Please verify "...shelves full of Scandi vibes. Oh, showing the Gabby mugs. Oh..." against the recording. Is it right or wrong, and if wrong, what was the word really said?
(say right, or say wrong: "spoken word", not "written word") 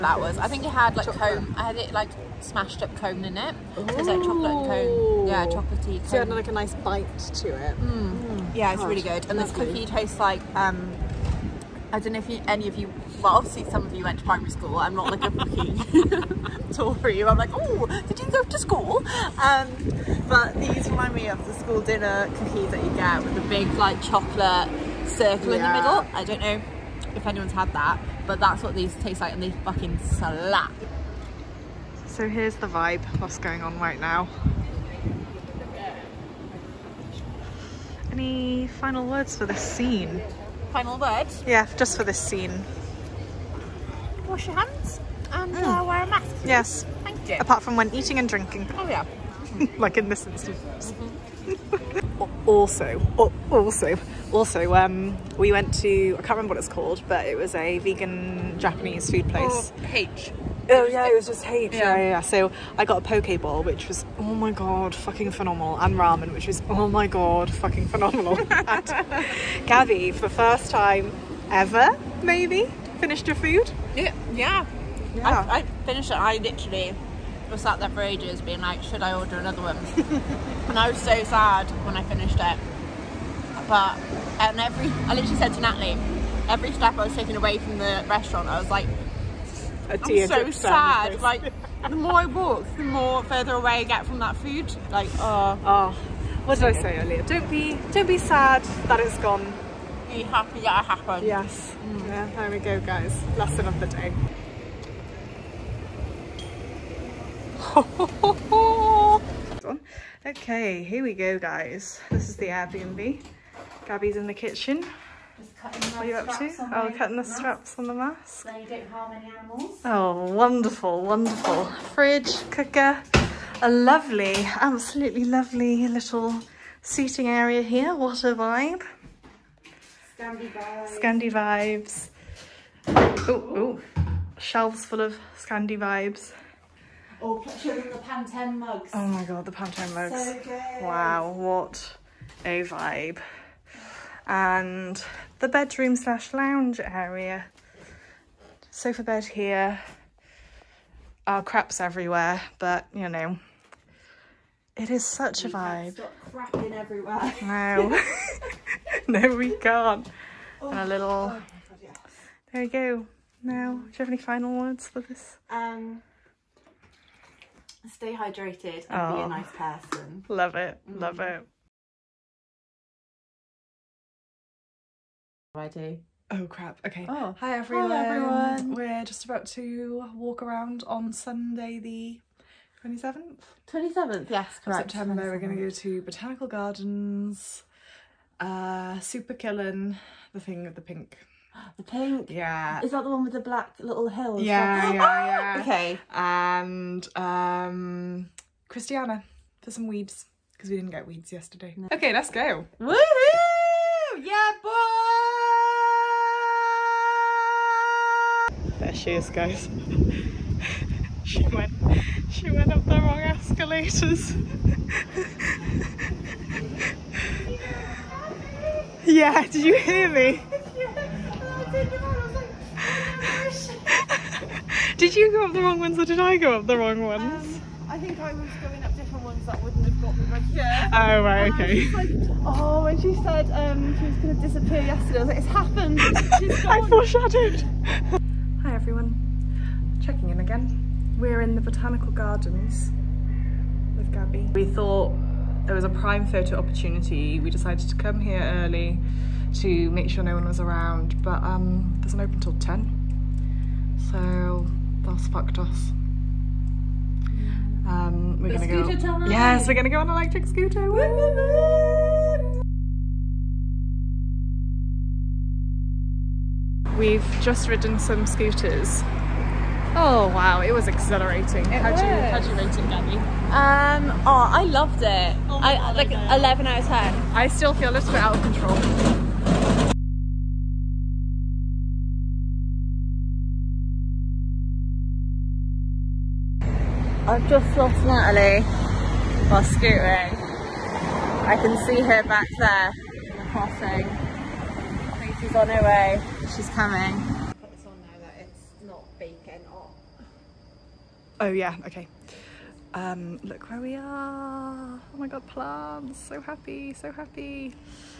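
wrong: "Pantone", not "Gabby".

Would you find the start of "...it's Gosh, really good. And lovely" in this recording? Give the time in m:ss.
0:08.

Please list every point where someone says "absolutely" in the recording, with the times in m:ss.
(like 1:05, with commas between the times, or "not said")
2:04.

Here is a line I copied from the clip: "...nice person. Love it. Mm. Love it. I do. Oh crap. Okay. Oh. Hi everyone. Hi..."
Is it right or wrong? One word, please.
right.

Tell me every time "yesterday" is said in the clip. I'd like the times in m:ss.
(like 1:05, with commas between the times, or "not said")
3:21, 3:54.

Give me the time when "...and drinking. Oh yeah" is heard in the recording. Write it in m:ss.
0:48.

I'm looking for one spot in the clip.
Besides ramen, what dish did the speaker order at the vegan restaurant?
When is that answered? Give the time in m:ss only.
1:03.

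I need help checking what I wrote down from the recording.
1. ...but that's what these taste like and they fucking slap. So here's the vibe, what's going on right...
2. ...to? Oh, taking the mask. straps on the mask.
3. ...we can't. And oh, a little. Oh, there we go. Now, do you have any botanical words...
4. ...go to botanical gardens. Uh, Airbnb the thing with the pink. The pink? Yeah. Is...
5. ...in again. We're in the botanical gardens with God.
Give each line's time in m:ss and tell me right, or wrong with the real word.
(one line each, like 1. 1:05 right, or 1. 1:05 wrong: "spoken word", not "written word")
1. 0:28 right
2. 1:56 wrong: "cutting", not "taking"
3. 2:39 wrong: "final", not "botanical"
4. 3:05 wrong: "Superkilen", not "Airbnb"
5. 4:00 wrong: "Gabby", not "God".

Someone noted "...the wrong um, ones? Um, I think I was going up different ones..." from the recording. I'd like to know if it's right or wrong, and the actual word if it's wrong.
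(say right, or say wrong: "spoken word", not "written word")
right.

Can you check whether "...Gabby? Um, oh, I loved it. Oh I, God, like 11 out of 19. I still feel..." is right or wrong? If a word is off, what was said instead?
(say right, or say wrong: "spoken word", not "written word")
wrong: "10", not "19".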